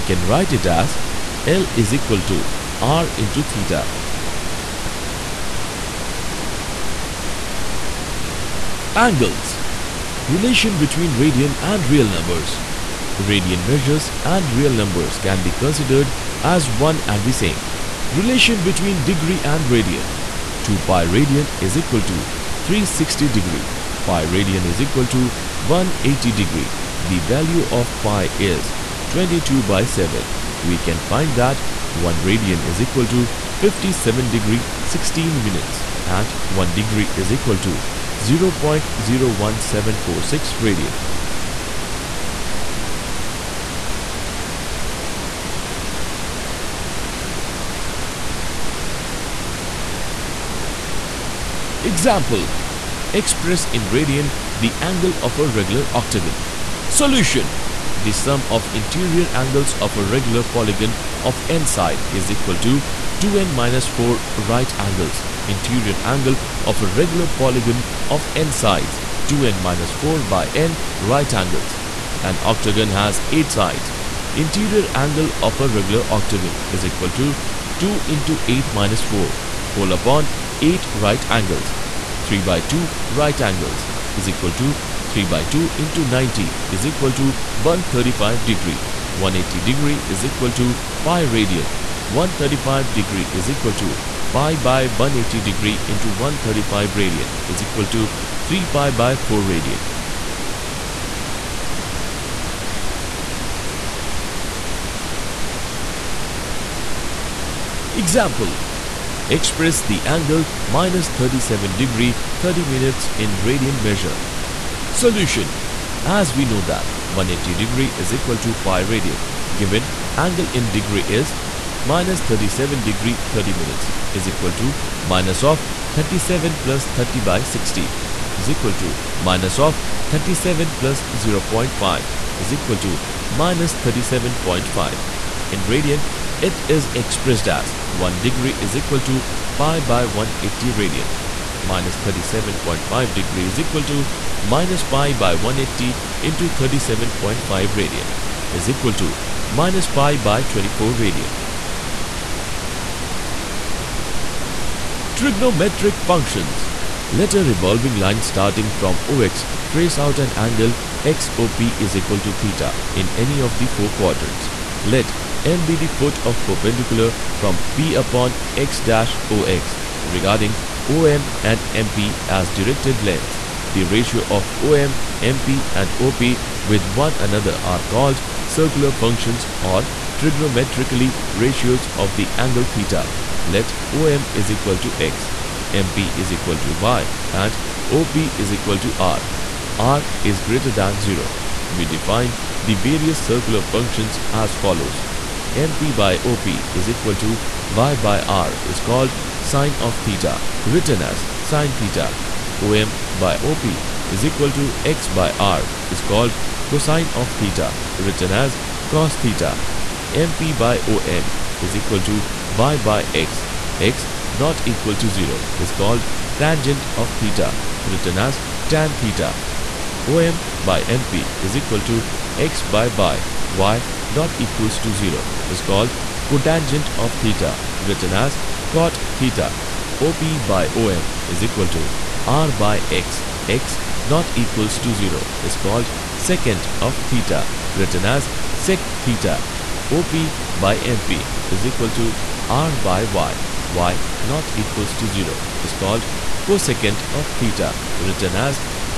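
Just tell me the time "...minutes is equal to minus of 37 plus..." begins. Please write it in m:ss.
2:03.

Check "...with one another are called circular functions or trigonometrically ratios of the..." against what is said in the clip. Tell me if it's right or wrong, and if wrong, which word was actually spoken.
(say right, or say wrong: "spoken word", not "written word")
right.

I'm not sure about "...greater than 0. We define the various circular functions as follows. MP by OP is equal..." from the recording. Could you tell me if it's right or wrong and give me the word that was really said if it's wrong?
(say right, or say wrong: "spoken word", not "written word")
right.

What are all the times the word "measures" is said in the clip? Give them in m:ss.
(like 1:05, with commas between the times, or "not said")
0:13, 1:53.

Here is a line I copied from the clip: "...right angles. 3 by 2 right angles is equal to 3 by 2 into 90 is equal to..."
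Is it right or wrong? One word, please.
right.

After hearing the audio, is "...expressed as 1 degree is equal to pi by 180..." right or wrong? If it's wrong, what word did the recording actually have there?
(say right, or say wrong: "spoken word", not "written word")
right.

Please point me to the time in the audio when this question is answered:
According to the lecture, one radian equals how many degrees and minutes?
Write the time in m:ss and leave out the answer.
0:33.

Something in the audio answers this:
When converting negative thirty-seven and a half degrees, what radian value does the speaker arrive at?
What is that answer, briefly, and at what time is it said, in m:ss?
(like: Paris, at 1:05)
-π/24 radian, at 2:29.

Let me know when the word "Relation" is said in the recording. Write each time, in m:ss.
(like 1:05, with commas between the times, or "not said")
0:10, 0:18.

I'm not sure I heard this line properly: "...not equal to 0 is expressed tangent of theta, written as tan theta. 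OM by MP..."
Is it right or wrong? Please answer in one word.
wrong.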